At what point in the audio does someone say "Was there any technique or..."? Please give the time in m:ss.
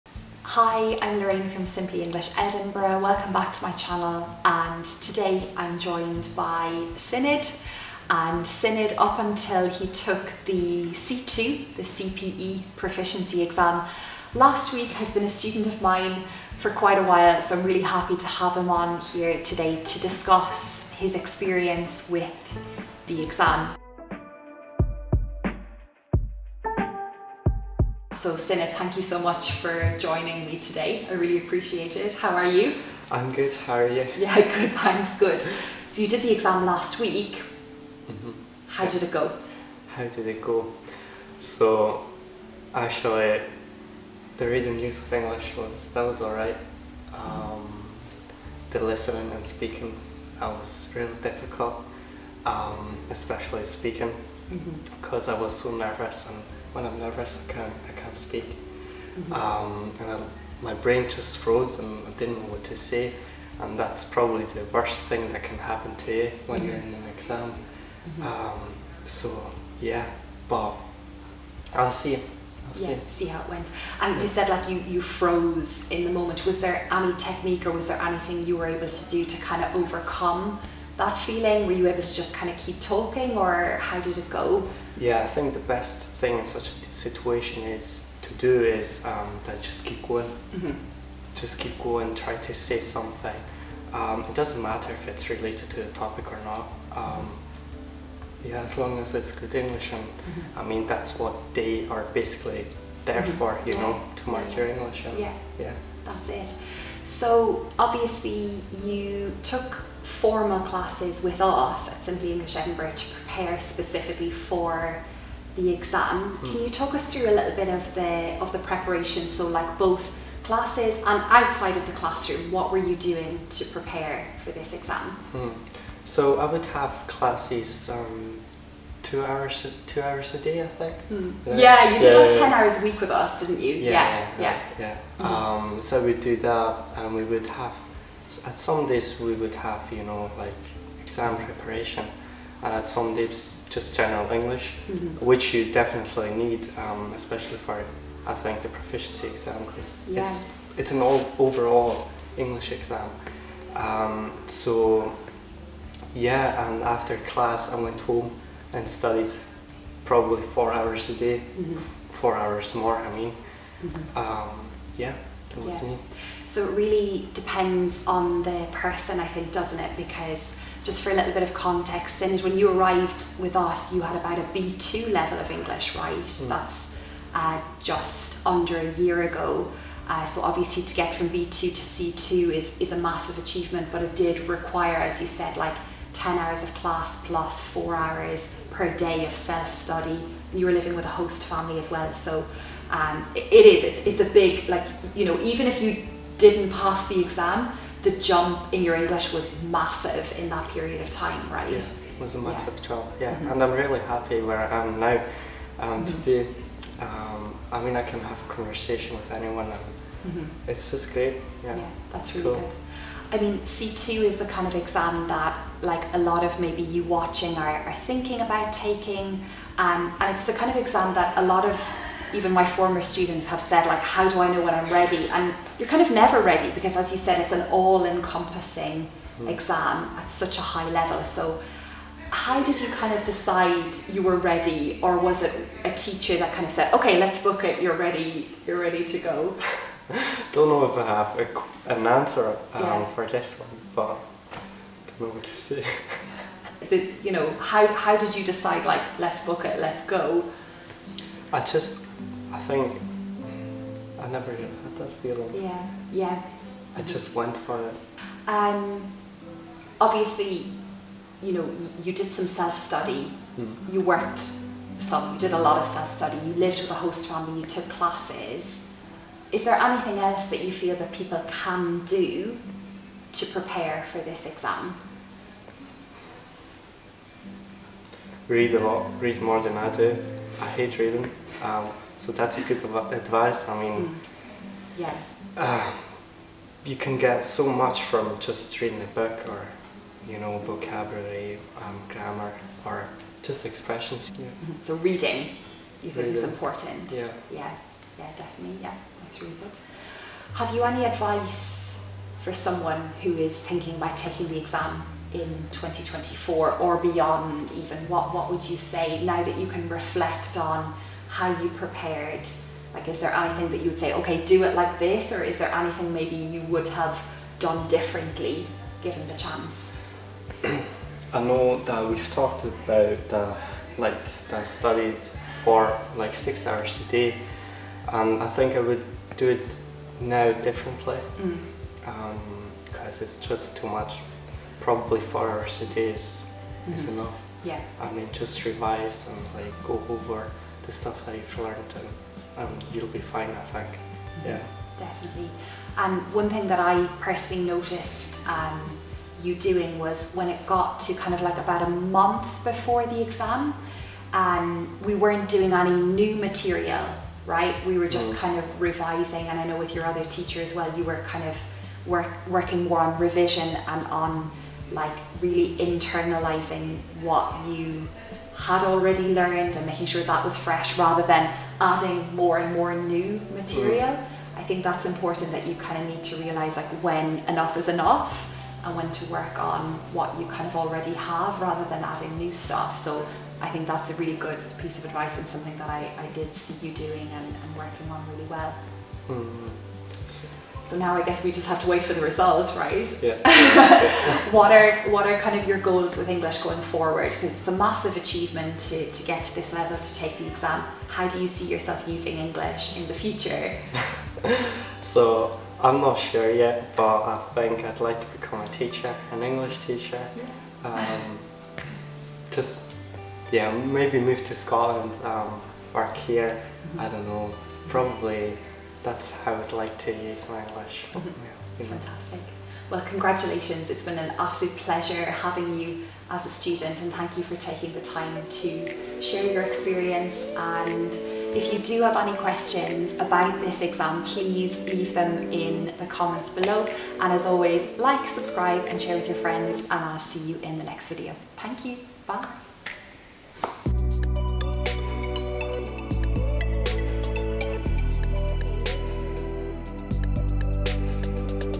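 1:16.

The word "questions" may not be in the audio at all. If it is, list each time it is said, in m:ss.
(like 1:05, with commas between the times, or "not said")
7:12.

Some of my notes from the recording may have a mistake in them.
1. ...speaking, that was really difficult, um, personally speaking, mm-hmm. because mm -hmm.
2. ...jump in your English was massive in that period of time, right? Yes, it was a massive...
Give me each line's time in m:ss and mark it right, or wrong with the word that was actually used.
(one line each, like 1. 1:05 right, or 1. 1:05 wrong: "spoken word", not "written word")
1. 0:49 wrong: "especially", not "personally"
2. 3:18 right.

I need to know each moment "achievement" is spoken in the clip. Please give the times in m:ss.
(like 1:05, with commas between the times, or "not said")
3:03, 6:38.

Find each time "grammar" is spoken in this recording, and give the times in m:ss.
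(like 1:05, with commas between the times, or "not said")
4:52.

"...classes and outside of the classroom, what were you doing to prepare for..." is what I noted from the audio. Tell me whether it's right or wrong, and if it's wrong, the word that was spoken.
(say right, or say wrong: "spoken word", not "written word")
right.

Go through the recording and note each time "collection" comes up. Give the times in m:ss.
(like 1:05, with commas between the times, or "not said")
not said.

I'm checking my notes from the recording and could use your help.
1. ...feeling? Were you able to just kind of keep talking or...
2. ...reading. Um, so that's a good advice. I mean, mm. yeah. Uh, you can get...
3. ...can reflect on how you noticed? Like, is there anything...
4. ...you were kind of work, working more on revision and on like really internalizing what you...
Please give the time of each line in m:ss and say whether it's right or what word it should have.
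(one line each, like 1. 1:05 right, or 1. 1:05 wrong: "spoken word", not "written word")
1. 1:21 right
2. 4:40 right
3. 5:09 wrong: "prepared", not "noticed"
4. 6:00 right.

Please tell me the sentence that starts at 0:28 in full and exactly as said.
So Sinead, thank you so much for joining me today.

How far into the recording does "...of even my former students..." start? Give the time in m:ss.
3:41.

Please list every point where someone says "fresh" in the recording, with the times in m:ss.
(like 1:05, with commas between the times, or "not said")
6:10.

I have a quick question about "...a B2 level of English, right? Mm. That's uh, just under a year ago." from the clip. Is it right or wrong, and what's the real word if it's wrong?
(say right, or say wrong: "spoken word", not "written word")
right.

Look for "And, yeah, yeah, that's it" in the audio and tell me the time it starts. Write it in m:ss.
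1:45.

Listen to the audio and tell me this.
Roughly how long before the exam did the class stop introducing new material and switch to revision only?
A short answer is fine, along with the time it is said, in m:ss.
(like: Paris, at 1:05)
a month, at 5:51.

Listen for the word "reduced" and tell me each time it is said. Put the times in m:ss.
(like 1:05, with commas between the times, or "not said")
not said.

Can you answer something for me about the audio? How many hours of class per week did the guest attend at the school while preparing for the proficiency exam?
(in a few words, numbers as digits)
10.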